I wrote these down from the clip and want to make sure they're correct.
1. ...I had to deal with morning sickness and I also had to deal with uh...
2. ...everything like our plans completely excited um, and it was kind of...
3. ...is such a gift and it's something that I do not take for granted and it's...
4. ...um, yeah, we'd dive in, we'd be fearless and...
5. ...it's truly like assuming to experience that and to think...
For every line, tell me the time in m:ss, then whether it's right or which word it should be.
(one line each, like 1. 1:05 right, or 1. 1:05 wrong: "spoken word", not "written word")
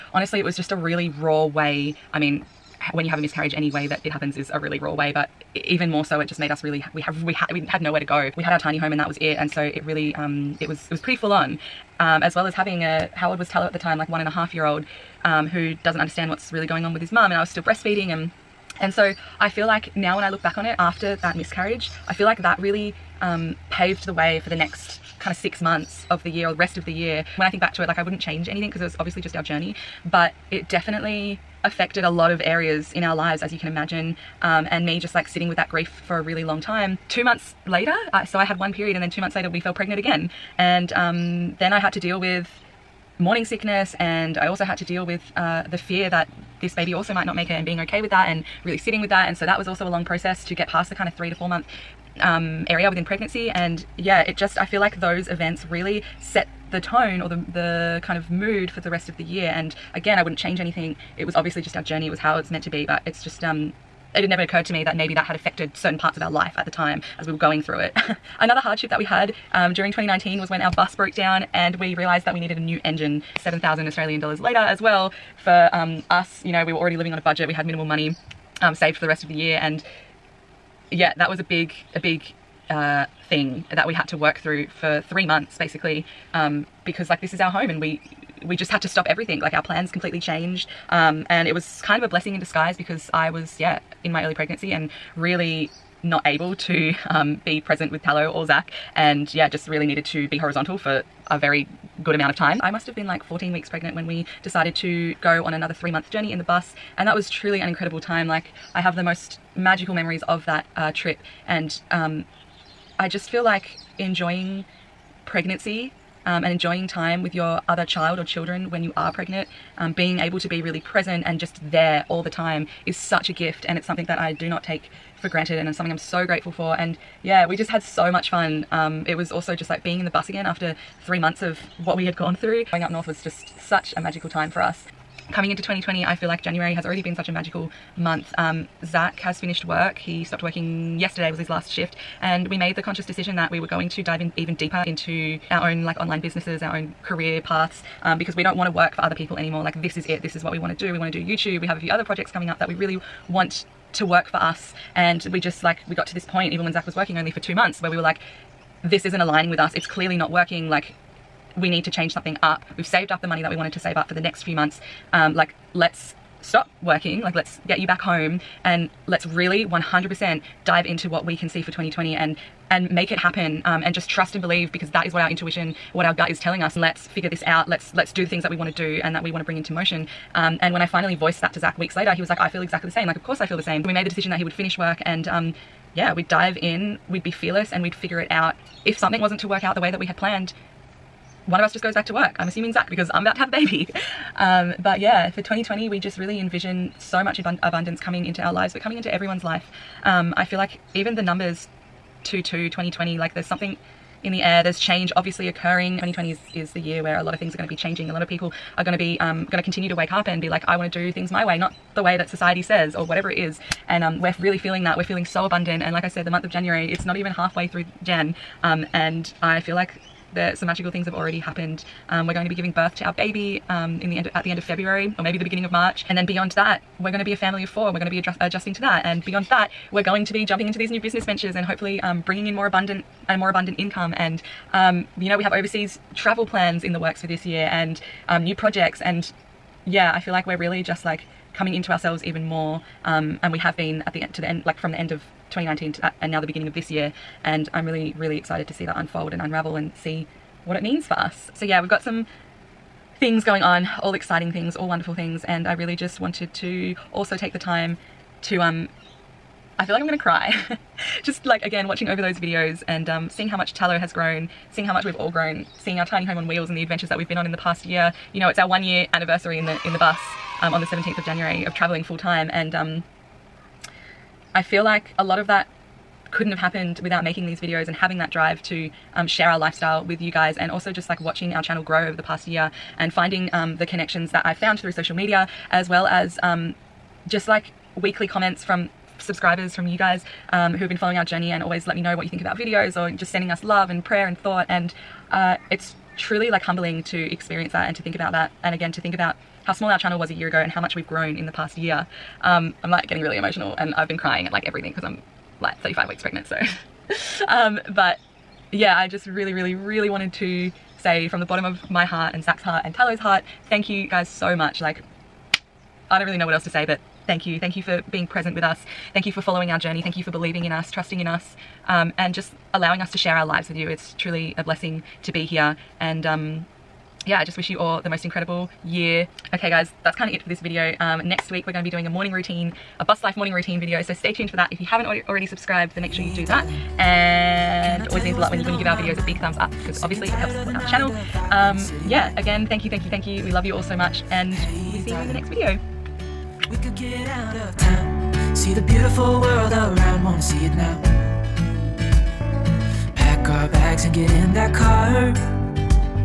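1. 0:41 right
2. 1:29 wrong: "changed", not "excited"
3. 2:02 right
4. 3:05 right
5. 4:55 wrong: "humbling", not "assuming".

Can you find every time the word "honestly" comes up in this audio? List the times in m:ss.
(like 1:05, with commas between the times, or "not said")
0:00.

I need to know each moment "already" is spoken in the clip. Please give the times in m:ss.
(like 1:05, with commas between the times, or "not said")
1:16, 2:16, 3:41, 5:35.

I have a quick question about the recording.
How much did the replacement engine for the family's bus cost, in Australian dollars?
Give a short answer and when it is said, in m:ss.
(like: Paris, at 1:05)
7,000 Australian dollars, at 1:13.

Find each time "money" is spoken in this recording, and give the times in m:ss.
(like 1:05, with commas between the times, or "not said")
1:17, 2:43.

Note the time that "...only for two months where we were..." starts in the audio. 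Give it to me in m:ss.
2:37.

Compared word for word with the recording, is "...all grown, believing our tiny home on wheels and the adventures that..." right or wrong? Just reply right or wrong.
wrong.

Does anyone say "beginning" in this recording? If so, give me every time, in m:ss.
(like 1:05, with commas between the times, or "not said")
3:45, 4:06.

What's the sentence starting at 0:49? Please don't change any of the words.
And so that was also a long process to get past the kind of three to four month um, area within pregnancy.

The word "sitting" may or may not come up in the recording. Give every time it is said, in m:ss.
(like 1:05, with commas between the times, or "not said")
0:35, 0:48.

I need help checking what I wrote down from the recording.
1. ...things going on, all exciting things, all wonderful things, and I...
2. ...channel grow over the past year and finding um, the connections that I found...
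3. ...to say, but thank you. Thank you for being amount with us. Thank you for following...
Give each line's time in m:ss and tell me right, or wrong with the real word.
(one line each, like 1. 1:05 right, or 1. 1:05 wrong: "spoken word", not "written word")
1. 4:13 right
2. 4:41 right
3. 5:16 wrong: "present", not "amount".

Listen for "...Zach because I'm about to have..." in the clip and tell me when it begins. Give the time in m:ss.
3:12.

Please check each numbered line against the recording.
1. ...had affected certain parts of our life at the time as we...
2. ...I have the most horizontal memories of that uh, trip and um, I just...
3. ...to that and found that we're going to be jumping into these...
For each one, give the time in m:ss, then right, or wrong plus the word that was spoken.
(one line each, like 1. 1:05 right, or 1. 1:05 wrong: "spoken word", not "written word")
1. 1:05 right
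2. 1:48 wrong: "magical", not "horizontal"
3. 3:48 wrong: "beyond", not "found".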